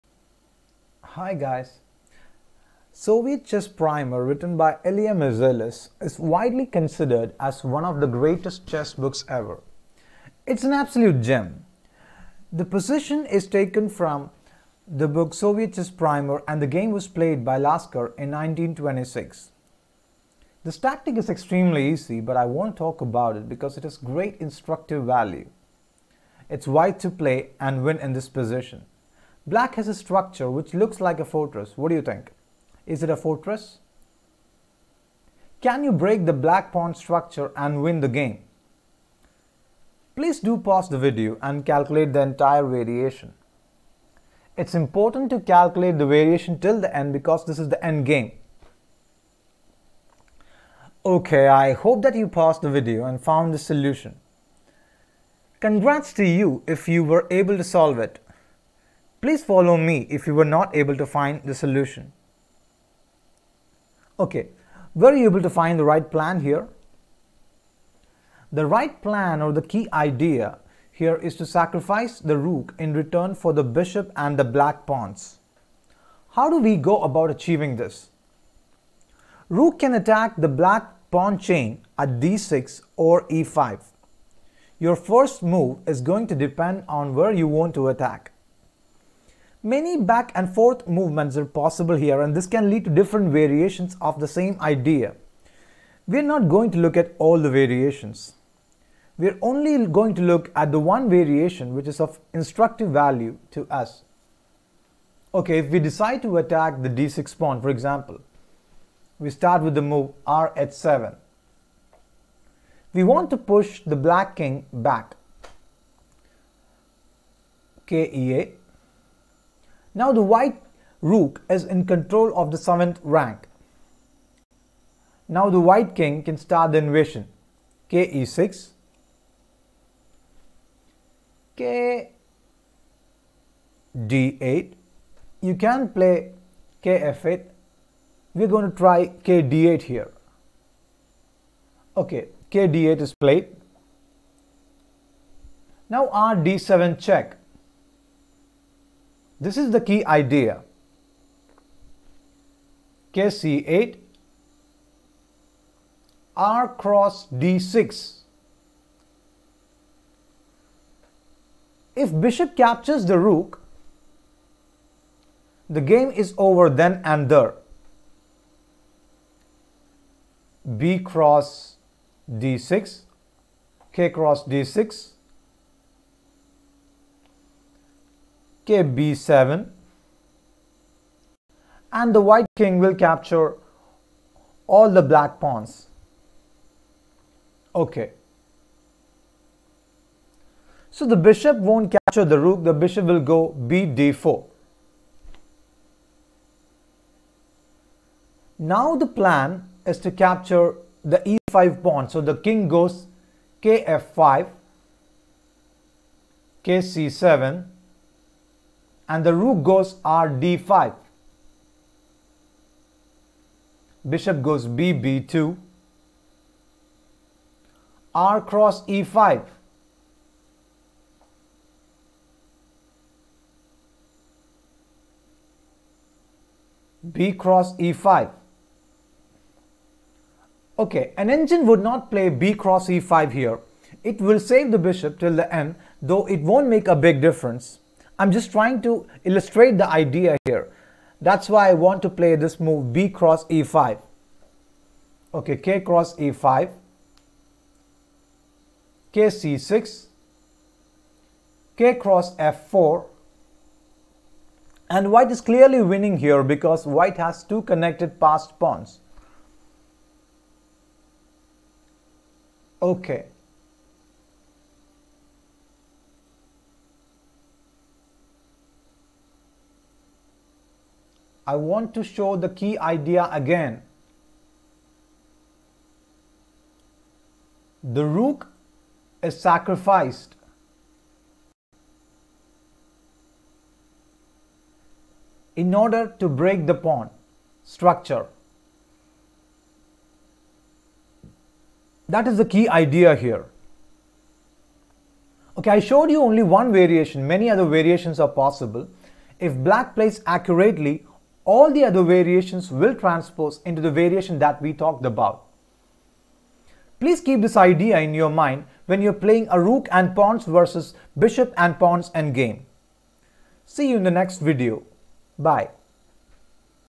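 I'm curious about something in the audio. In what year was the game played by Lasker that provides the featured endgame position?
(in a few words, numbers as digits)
1926.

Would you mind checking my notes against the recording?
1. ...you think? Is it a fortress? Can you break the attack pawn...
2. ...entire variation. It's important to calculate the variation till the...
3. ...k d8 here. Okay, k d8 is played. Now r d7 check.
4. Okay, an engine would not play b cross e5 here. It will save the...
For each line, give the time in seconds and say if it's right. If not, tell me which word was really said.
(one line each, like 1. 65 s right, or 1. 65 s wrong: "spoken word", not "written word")
1. 31 s wrong: "black", not "attack"
2. 42 s right
3. 139 s right
4. 230 s right.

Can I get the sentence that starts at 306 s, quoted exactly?
Please keep this idea in your mind when you're playing a rook and pawns versus bishop and pawns endgame.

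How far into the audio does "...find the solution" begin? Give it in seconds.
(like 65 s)
61 s.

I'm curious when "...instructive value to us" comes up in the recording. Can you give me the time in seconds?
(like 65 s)
102 s.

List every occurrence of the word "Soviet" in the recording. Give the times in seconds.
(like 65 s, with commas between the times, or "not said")
2 s, 15 s.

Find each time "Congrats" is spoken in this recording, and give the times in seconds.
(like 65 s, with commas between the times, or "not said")
55 s.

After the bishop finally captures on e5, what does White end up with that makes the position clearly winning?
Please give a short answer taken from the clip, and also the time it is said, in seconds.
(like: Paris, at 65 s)
Two connected passed pawns, at 257 s.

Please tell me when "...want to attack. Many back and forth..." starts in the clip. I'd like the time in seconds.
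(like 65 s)
87 s.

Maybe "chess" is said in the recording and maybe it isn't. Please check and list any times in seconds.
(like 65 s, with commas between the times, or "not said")
3 s, 8 s, 15 s.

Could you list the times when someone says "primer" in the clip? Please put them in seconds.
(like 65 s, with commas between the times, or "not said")
3 s, 15 s.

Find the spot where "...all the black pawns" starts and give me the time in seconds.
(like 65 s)
184 s.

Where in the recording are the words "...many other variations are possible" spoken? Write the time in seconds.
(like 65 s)
297 s.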